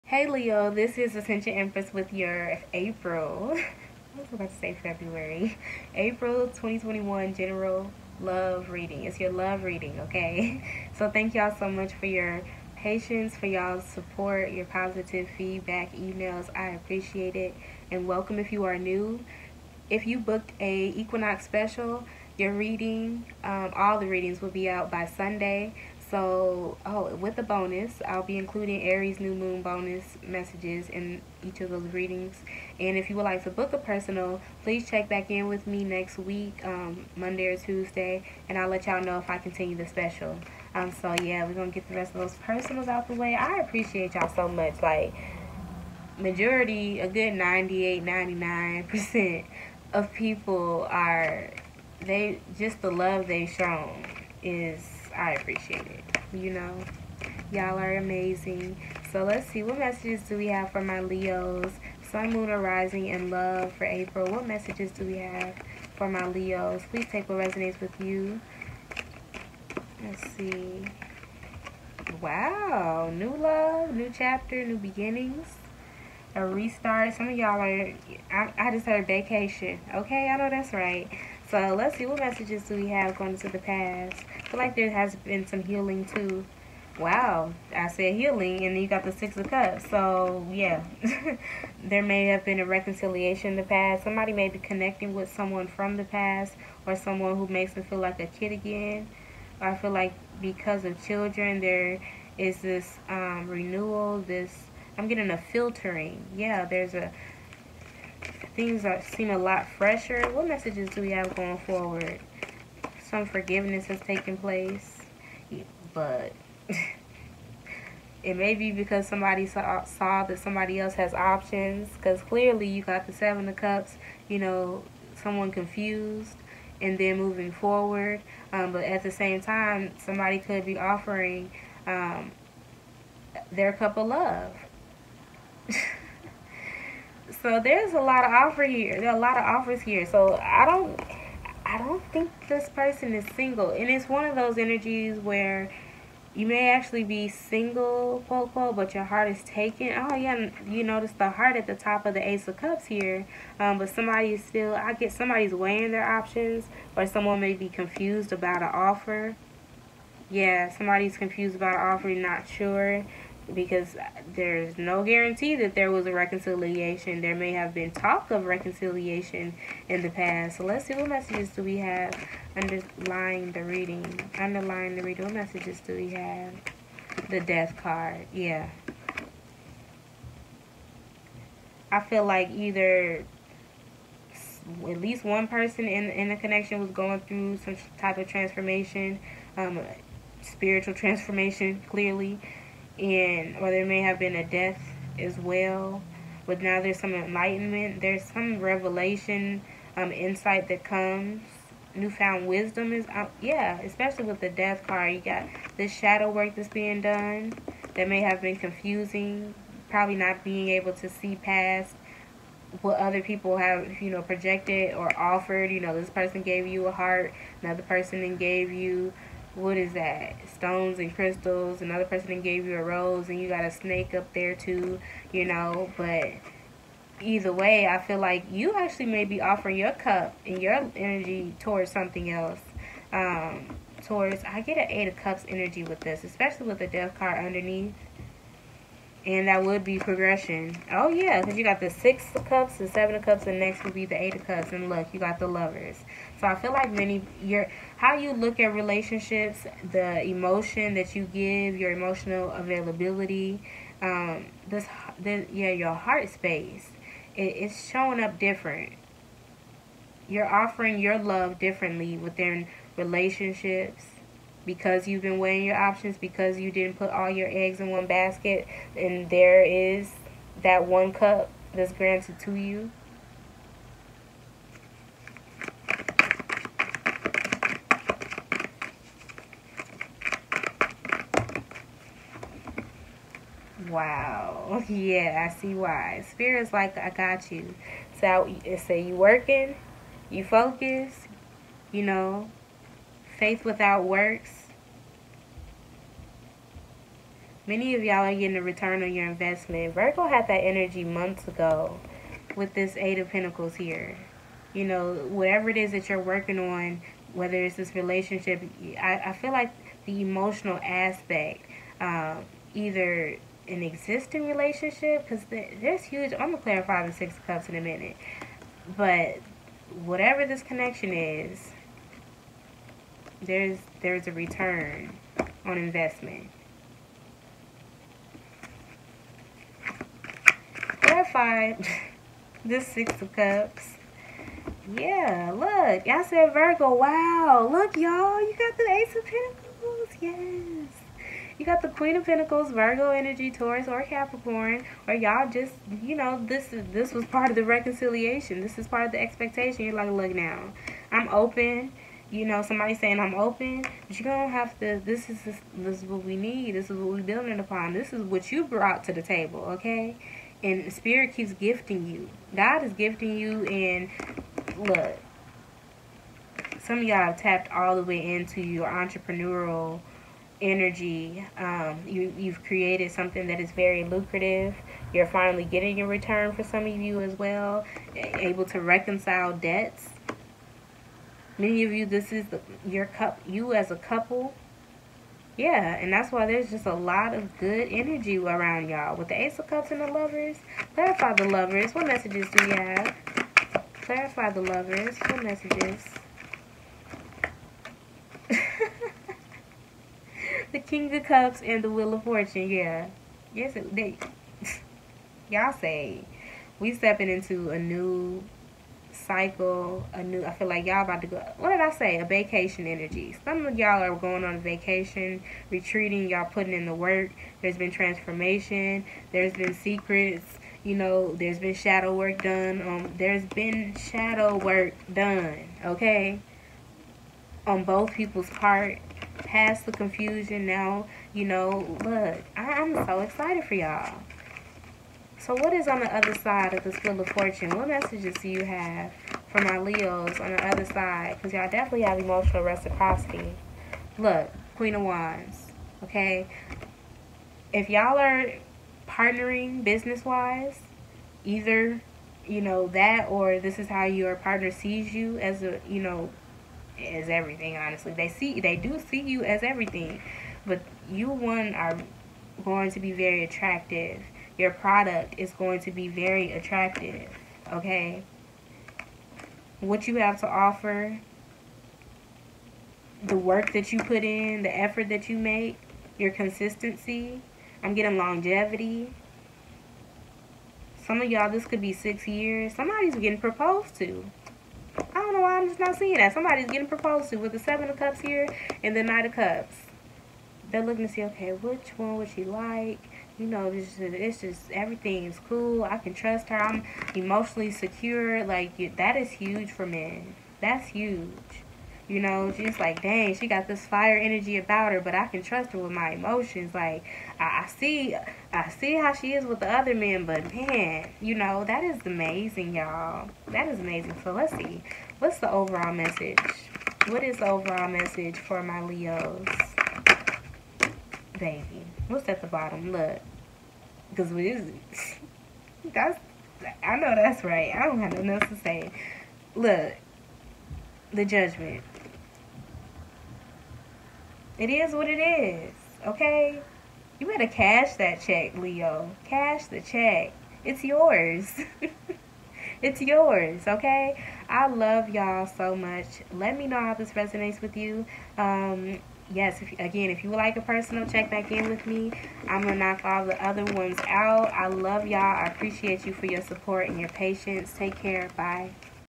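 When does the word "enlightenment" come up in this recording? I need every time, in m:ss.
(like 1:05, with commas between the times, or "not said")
3:17.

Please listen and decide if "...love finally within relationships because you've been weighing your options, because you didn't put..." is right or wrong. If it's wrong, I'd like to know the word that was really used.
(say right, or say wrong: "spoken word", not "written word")
wrong: "differently", not "finally".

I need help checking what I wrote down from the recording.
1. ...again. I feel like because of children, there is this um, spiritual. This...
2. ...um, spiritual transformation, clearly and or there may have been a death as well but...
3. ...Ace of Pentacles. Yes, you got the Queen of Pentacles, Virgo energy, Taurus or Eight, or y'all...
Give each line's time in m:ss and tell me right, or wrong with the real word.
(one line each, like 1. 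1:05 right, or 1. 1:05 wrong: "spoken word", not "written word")
1. 1:38 wrong: "renewal", not "spiritual"
2. 3:09 right
3. 5:38 wrong: "Capricorn", not "Eight".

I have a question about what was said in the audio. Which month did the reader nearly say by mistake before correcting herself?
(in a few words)
February.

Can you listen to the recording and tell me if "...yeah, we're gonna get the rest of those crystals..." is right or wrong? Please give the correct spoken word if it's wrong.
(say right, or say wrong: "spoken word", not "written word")
wrong: "personals", not "crystals".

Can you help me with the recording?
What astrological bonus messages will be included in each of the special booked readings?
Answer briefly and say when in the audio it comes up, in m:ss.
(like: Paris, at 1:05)
Aries new moon, at 0:28.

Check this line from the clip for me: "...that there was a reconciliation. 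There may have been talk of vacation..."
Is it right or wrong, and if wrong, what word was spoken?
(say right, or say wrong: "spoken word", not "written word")
wrong: "reconciliation", not "vacation".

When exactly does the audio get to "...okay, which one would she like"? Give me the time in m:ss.
8:11.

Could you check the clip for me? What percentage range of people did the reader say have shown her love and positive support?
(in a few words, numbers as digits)
98, 99%.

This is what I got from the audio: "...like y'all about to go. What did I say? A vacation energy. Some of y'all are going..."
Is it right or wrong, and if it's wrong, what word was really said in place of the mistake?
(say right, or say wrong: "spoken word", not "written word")
right.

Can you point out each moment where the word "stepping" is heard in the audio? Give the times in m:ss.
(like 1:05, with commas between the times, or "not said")
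6:46.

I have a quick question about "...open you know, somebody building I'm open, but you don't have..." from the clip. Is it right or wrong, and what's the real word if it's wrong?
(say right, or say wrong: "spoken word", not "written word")
wrong: "saying", not "building".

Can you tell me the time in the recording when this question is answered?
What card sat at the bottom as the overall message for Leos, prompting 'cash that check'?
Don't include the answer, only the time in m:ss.
8:51.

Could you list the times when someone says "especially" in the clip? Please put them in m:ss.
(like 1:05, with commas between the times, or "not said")
3:23, 3:56.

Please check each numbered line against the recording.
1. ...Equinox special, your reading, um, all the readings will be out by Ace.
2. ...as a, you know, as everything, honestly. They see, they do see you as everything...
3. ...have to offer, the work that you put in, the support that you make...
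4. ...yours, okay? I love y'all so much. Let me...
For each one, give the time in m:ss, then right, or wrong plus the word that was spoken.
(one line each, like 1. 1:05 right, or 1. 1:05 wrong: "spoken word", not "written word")
1. 0:20 wrong: "Sunday", not "Ace"
2. 7:35 right
3. 7:50 wrong: "effort", not "support"
4. 9:03 right.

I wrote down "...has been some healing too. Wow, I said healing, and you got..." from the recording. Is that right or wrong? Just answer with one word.
right.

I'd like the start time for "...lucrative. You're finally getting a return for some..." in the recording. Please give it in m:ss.
6:14.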